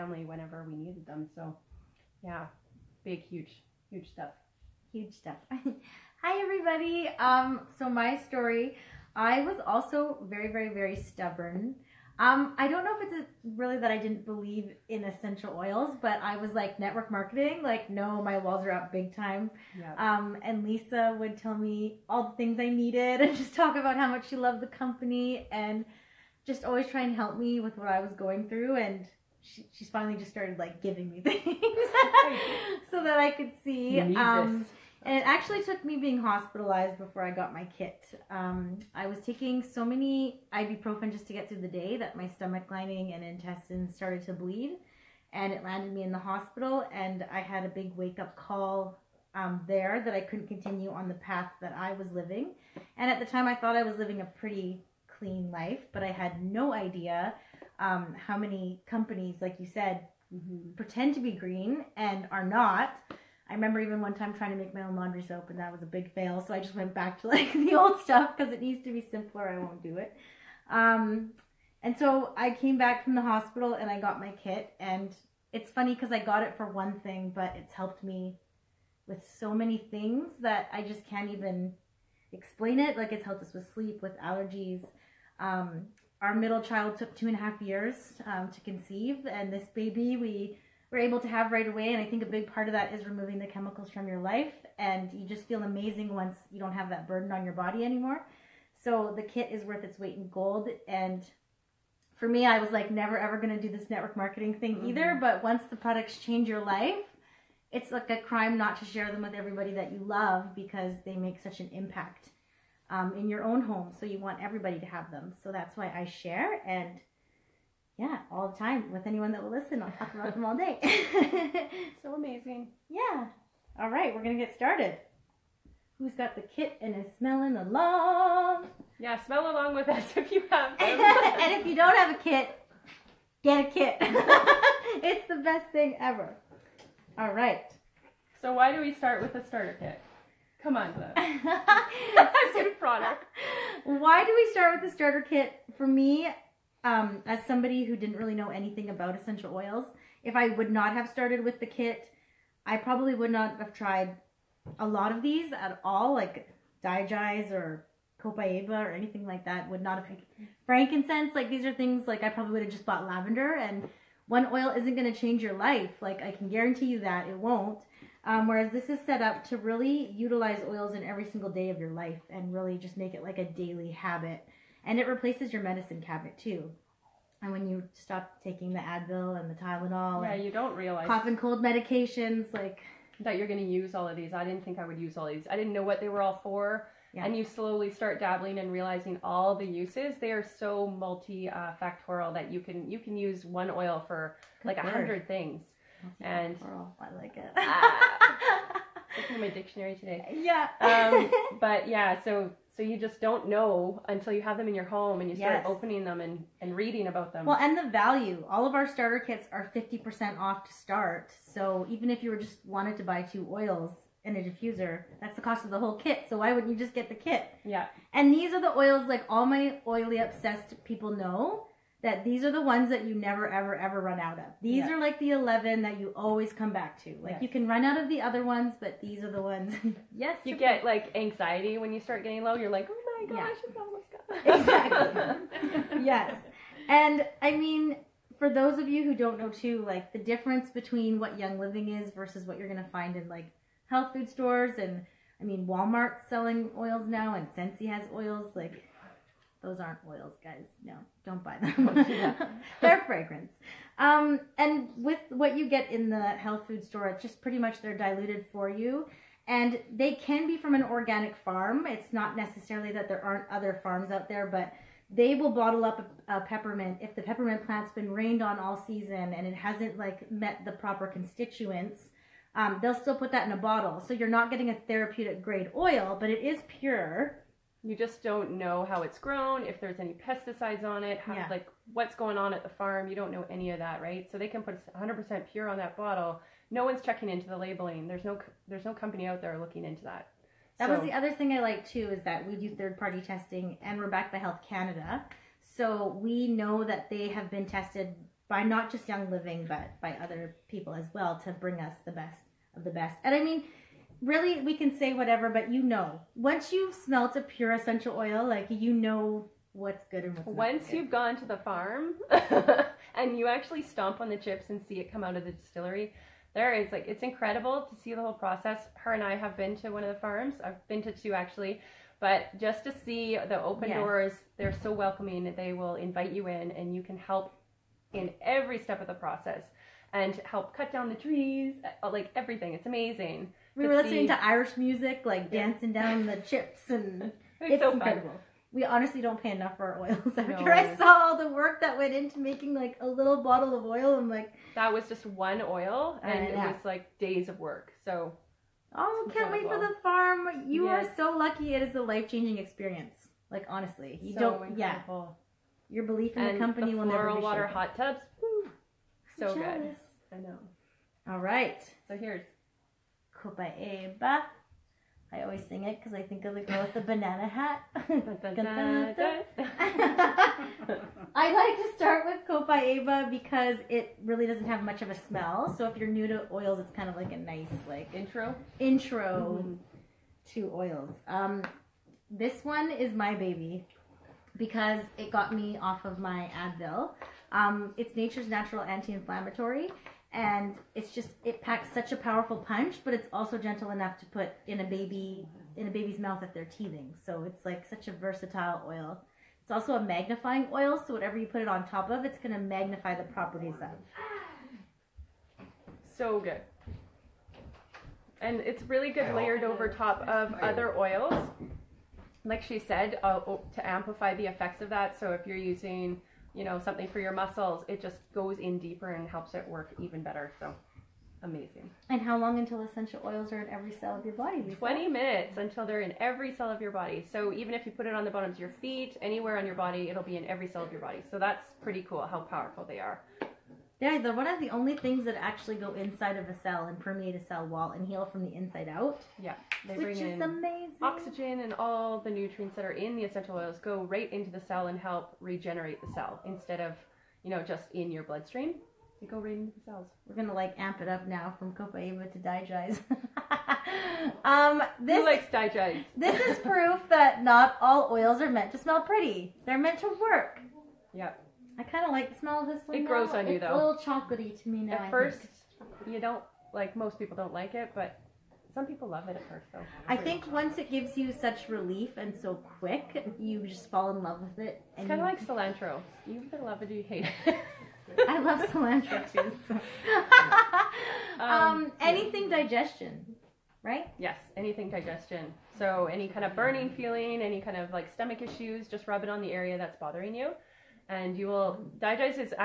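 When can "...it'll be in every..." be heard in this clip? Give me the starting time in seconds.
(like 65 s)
430 s.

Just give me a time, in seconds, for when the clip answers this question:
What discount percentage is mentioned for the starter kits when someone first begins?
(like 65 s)
209 s.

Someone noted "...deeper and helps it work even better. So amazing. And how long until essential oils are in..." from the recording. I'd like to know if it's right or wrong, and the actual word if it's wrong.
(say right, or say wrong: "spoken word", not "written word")
right.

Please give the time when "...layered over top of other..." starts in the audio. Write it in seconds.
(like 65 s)
409 s.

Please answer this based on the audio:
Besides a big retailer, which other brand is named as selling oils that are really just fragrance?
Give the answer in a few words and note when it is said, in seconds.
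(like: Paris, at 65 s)
Scentsy, at 247 s.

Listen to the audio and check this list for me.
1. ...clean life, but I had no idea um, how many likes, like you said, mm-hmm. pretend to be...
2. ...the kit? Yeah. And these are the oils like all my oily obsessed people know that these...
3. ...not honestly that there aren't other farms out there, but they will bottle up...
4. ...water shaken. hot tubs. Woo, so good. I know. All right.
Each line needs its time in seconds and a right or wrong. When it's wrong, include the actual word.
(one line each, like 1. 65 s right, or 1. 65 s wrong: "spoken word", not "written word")
1. 55 s wrong: "companies", not "likes"
2. 217 s right
3. 262 s wrong: "necessarily", not "honestly"
4. 357 s right.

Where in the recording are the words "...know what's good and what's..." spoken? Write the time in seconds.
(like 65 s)
308 s.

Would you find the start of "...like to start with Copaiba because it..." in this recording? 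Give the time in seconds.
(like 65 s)
371 s.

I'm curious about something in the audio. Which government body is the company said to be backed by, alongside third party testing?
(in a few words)
Health Canada.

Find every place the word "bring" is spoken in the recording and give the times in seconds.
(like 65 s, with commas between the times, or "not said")
301 s, 440 s.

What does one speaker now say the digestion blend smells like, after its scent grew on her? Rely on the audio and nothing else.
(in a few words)
chocolatey.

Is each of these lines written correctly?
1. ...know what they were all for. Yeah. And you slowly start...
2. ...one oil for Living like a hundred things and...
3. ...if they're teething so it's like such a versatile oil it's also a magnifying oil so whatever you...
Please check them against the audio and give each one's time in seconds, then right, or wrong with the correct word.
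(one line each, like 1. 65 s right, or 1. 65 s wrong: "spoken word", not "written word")
1. 185 s right
2. 193 s wrong: "Good", not "Living"
3. 396 s right.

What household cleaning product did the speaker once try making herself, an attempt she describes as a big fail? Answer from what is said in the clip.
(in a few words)
laundry soap.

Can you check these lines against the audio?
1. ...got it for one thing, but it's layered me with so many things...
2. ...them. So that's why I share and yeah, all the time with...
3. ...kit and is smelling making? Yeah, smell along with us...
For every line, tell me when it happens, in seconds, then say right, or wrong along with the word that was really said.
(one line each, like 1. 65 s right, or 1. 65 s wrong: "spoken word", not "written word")
1. 76 s wrong: "helped", not "layered"
2. 115 s right
3. 126 s wrong: "along", not "making".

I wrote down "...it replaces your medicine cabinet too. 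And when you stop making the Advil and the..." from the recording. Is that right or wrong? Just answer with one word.
wrong.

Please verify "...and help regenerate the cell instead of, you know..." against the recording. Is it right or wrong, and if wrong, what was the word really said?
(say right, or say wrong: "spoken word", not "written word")
right.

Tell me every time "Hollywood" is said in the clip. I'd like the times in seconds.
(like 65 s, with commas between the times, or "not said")
not said.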